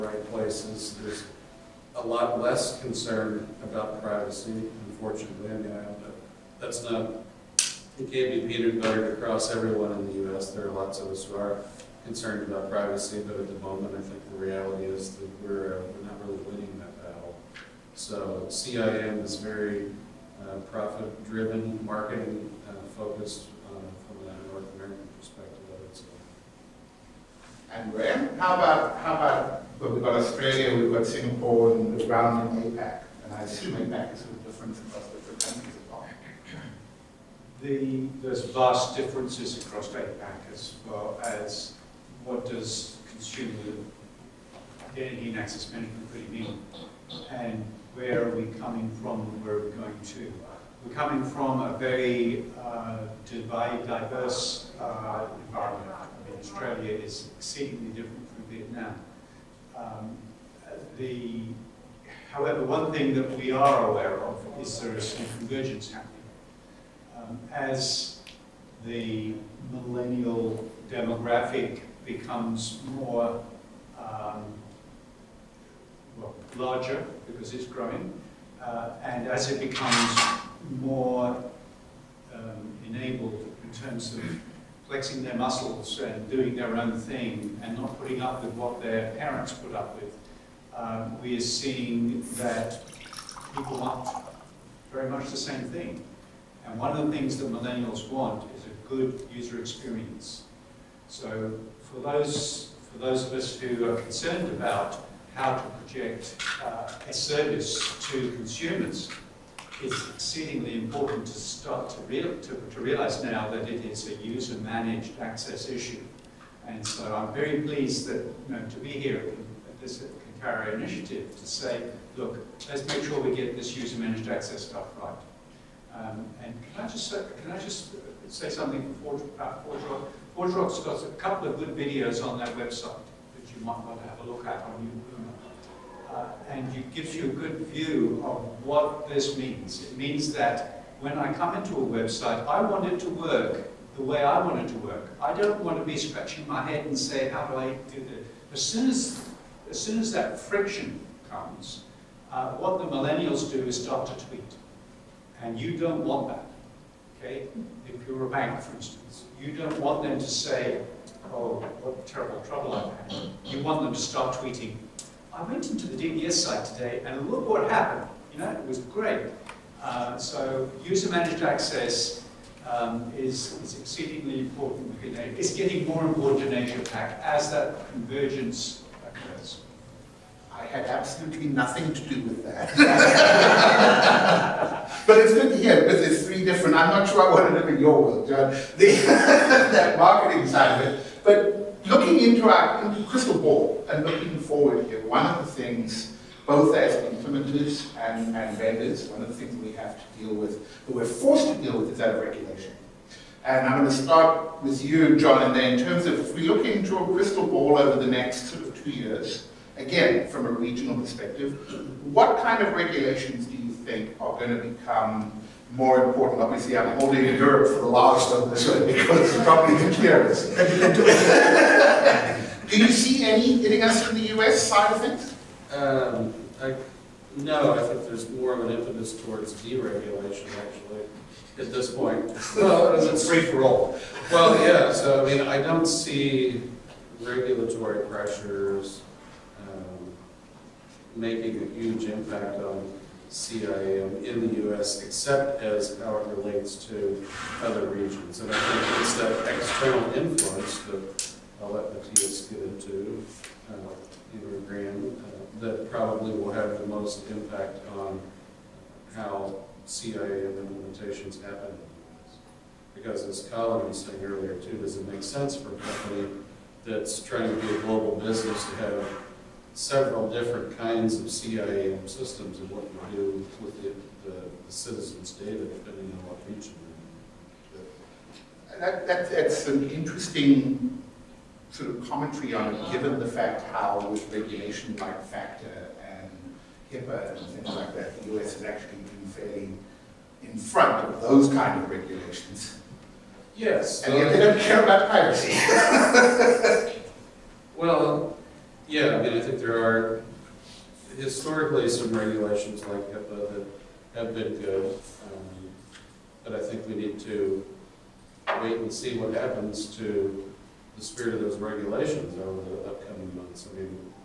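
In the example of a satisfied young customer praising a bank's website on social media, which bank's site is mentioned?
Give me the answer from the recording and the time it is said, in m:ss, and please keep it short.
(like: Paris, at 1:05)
DBS, at 2:46.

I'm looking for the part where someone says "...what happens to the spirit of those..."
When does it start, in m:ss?
5:09.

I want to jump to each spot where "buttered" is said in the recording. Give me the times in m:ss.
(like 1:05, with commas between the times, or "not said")
0:08.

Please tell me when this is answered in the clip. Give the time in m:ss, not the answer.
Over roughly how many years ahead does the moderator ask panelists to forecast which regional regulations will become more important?
3:28.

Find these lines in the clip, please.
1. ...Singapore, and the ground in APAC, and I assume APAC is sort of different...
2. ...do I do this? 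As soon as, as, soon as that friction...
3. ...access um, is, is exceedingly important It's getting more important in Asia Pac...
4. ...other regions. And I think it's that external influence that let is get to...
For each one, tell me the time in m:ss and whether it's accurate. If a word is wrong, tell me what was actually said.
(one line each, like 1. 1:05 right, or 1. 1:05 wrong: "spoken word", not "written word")
1. 0:31 right
2. 2:27 right
3. 2:51 right
4. 4:07 right.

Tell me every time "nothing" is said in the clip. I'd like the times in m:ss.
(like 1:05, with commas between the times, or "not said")
3:01.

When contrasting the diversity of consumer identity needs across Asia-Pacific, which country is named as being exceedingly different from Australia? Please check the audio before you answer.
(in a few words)
Vietnam.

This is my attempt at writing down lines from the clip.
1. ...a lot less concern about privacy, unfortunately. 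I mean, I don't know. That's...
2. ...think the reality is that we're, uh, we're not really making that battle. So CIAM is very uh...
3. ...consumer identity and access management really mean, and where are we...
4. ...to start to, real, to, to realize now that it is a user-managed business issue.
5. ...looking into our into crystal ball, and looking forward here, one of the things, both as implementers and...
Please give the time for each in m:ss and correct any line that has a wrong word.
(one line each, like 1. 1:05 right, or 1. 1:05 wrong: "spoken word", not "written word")
1. 0:01 right
2. 0:14 wrong: "winning", not "making"
3. 0:43 right
4. 1:51 wrong: "access", not "business"
5. 3:11 right.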